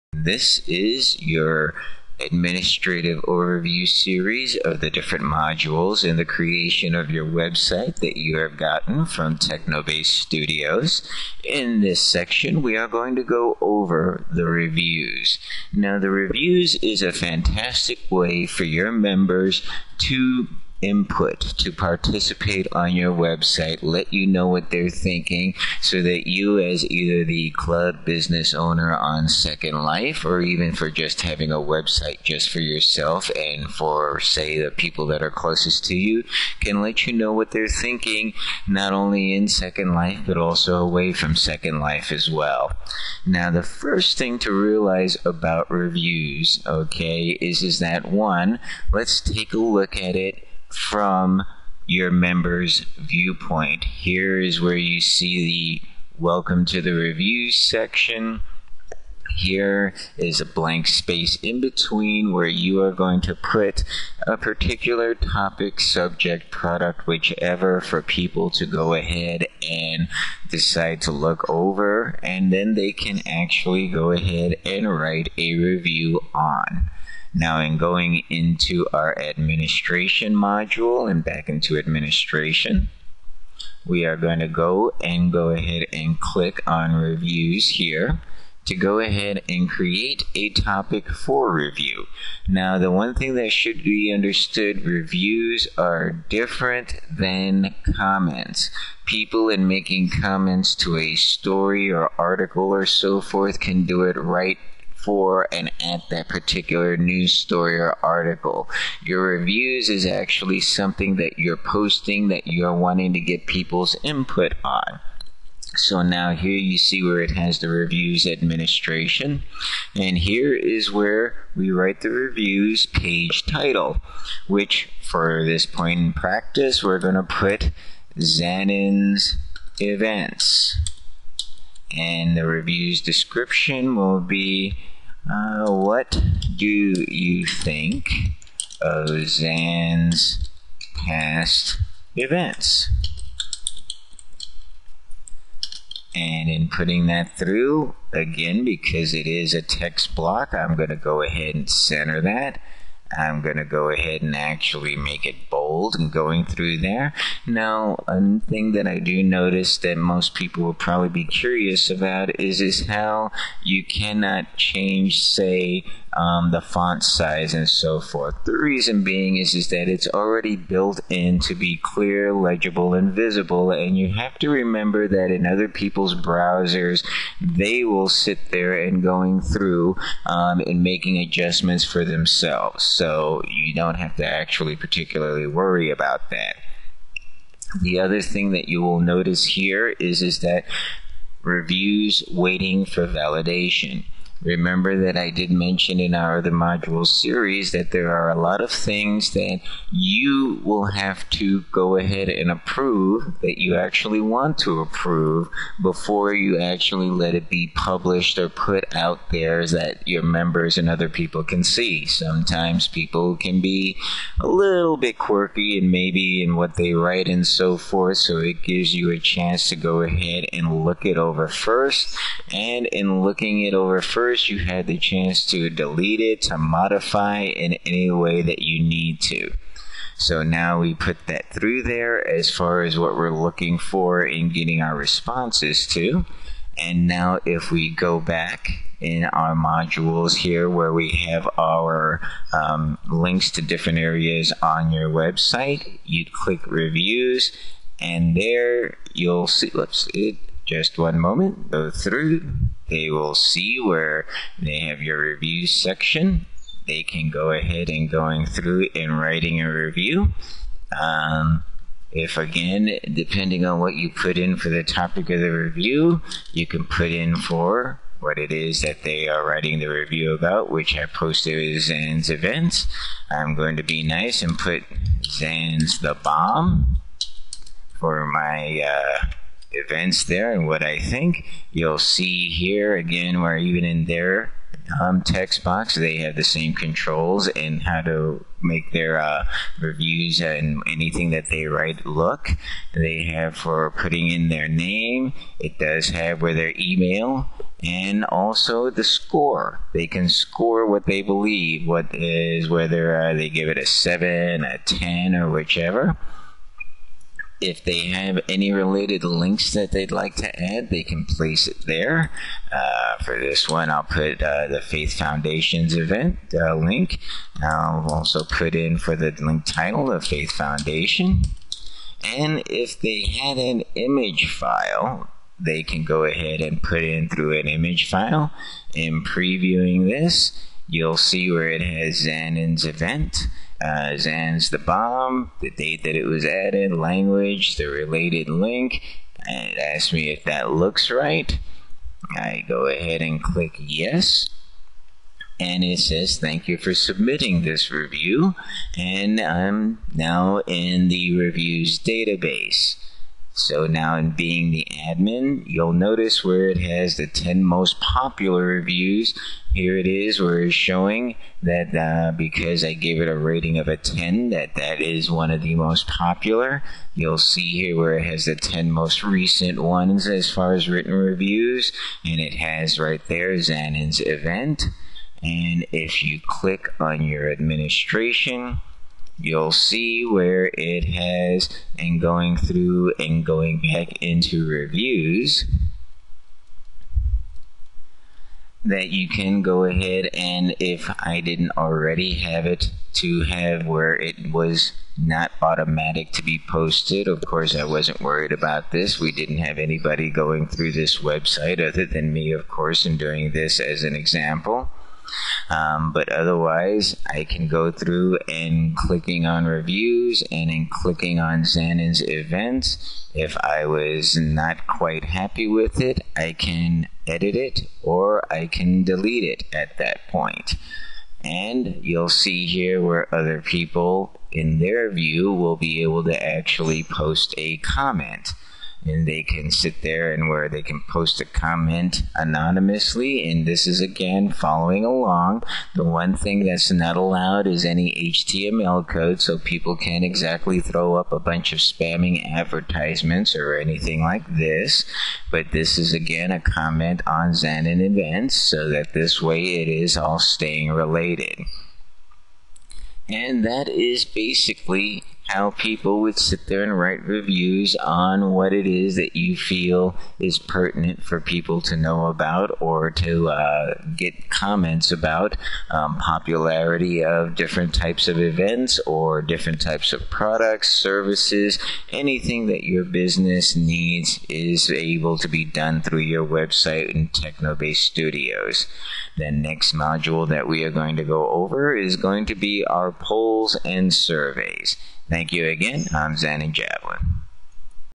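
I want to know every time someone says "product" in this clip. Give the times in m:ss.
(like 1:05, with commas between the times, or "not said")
1:06, 7:50.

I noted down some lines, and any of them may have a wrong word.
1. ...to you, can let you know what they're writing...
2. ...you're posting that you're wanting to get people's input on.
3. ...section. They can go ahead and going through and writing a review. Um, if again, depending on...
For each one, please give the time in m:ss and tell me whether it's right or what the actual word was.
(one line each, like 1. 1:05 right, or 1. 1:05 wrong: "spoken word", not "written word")
1. 0:35 wrong: "thinking", not "writing"
2. 1:51 right
3. 4:15 right.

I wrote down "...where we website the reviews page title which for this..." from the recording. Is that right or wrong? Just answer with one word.
wrong.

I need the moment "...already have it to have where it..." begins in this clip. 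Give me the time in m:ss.
6:31.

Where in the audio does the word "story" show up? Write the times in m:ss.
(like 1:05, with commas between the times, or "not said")
1:41, 1:47.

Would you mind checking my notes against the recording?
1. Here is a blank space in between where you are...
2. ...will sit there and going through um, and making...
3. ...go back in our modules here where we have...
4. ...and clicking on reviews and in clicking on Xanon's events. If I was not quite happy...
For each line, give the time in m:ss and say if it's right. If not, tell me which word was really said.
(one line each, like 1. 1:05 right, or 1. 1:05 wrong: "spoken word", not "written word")
1. 0:59 right
2. 2:57 right
3. 3:57 right
4. 6:48 right.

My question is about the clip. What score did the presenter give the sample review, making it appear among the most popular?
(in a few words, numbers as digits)
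10.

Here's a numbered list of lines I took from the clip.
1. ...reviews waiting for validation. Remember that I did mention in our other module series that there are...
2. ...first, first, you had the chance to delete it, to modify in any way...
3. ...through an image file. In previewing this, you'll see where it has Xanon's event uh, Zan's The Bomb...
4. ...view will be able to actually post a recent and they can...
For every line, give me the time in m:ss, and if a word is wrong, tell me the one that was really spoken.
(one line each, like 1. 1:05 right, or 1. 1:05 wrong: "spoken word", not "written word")
1. 3:11 right
2. 3:44 right
3. 5:27 right
4. 7:05 wrong: "comment", not "recent".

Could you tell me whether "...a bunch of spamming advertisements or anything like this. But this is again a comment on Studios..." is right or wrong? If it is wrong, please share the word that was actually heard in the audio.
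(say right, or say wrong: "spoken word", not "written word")
wrong: "Xanon", not "Studios".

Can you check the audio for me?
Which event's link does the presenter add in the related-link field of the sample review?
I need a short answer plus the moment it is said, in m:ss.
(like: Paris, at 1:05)
Faith Foundations, at 5:14.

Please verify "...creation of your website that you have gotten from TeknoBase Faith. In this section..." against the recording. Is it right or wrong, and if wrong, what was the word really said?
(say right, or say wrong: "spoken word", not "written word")
wrong: "Studios", not "Faith".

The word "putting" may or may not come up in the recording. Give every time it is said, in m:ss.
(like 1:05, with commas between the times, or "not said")
2:26, 4:53.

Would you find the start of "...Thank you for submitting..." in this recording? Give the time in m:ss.
5:46.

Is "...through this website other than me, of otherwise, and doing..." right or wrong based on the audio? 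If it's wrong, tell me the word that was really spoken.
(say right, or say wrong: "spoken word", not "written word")
wrong: "course", not "otherwise".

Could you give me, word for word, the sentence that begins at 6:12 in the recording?
And it has right there Xanon's event.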